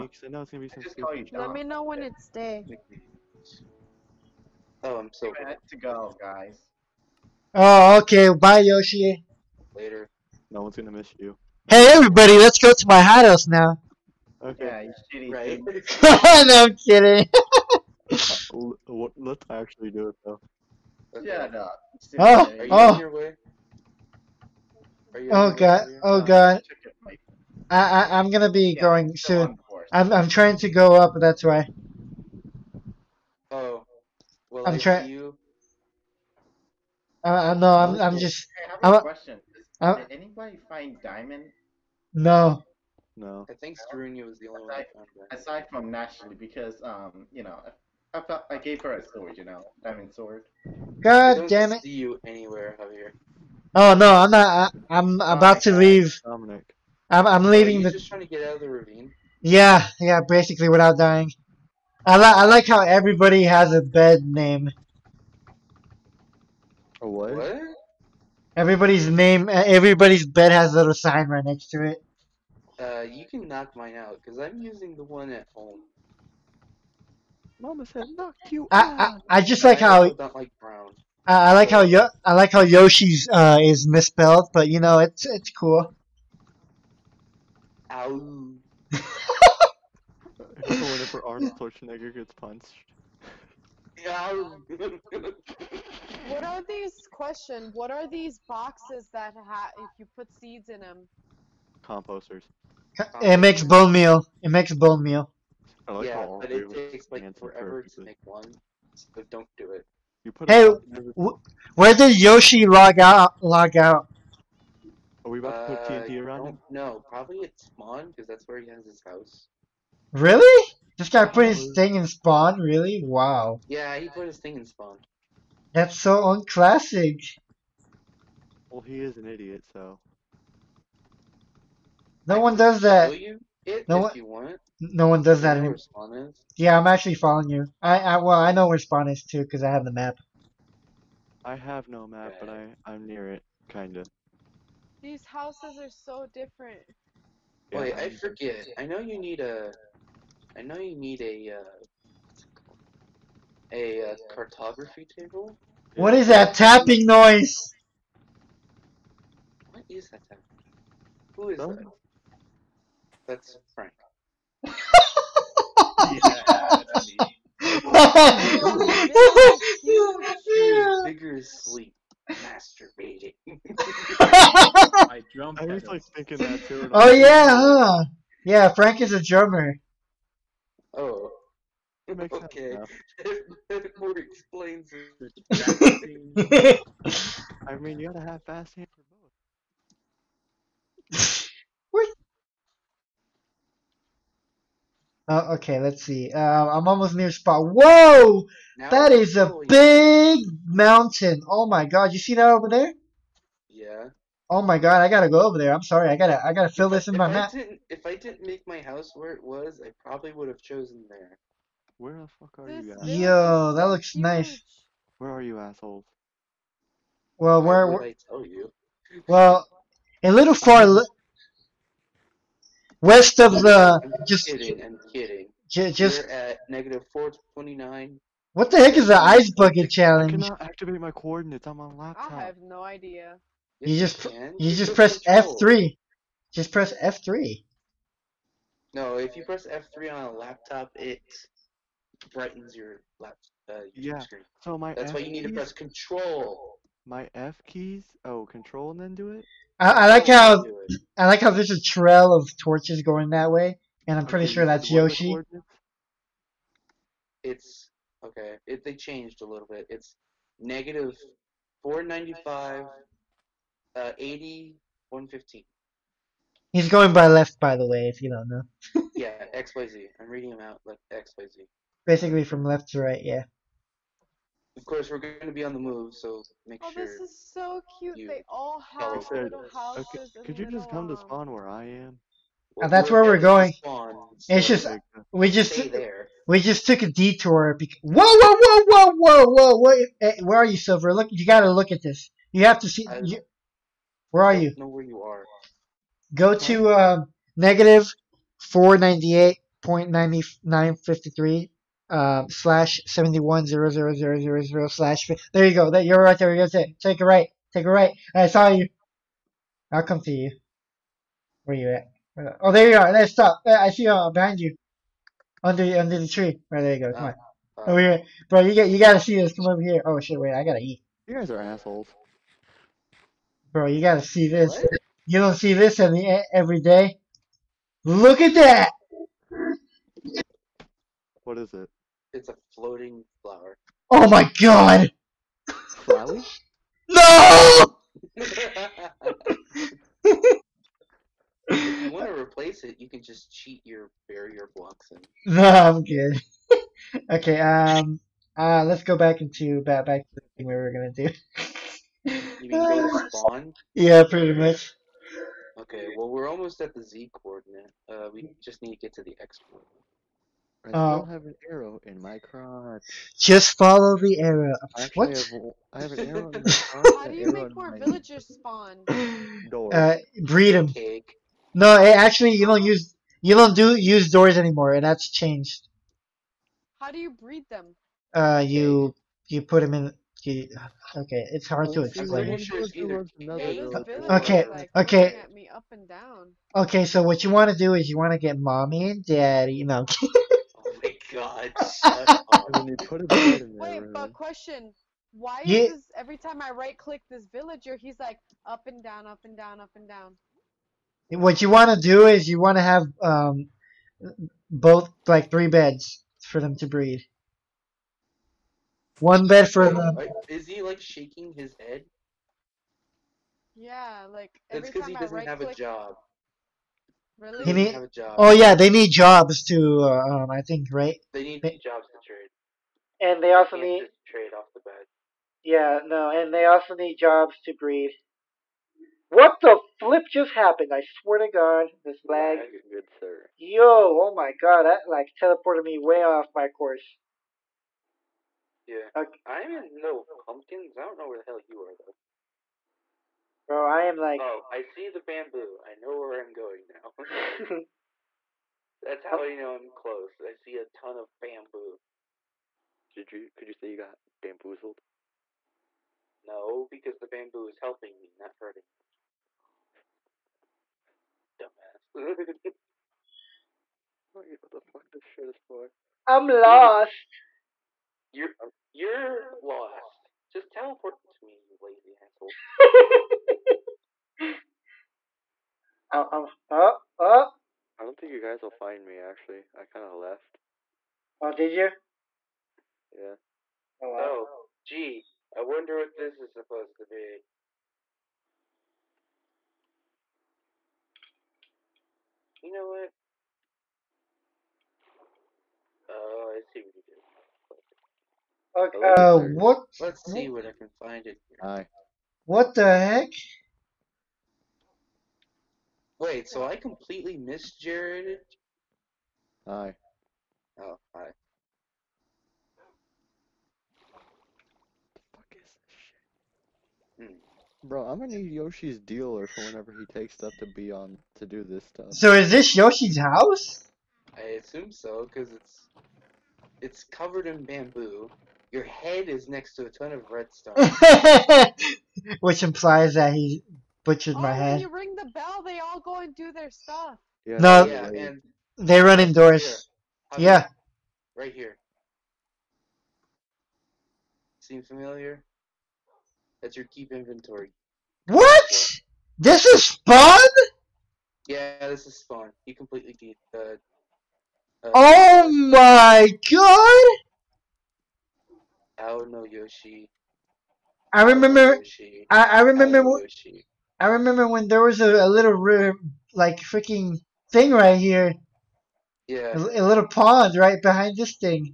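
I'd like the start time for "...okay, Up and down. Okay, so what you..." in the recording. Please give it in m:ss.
6:24.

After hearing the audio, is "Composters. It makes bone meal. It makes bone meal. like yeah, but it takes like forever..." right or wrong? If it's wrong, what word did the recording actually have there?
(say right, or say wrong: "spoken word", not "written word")
right.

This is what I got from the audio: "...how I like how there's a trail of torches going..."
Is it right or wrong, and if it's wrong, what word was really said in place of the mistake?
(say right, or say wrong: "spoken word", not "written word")
right.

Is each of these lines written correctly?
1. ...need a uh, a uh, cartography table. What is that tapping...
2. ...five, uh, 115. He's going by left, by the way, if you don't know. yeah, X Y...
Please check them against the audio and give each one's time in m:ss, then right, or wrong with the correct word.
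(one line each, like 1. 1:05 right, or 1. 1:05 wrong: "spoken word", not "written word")
1. 2:30 right
2. 4:22 right.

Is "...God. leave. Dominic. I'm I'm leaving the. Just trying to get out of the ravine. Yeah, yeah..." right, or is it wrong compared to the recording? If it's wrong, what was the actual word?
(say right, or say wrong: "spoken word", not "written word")
right.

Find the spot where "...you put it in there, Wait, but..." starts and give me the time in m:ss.
6:32.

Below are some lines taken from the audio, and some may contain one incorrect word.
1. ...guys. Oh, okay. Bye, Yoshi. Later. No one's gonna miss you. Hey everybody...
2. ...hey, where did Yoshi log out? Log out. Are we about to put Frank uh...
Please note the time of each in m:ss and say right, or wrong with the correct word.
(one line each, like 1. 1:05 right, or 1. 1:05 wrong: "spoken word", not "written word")
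1. 0:06 right
2. 1:50 wrong: "TNT", not "Frank".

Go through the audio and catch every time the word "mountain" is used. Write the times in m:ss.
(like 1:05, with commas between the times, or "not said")
3:20.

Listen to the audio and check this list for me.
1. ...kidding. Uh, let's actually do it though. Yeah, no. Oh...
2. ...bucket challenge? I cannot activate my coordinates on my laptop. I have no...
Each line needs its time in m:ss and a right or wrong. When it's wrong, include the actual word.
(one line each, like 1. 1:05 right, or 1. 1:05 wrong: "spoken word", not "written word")
1. 0:16 right
2. 3:49 right.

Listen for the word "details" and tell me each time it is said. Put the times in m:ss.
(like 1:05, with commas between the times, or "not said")
not said.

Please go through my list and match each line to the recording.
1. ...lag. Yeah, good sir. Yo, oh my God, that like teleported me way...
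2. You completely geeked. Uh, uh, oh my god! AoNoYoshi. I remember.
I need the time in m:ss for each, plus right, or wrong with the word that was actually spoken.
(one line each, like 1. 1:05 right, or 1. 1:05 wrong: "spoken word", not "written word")
1. 7:12 right
2. 9:12 right.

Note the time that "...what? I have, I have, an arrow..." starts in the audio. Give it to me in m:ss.
6:05.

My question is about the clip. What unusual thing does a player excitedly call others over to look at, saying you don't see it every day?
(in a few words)
A floating flower.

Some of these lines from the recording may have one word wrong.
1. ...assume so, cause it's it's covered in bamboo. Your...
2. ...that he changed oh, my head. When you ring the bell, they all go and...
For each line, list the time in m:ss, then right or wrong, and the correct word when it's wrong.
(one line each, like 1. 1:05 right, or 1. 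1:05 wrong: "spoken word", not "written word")
1. 8:44 right
2. 8:53 wrong: "butchered", not "changed".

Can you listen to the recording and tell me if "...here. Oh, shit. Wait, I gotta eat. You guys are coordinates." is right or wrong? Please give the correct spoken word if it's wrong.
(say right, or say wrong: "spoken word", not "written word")
wrong: "assholes", not "coordinates".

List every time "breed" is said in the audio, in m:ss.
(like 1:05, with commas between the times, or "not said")
6:10, 6:17, 6:46, 7:07.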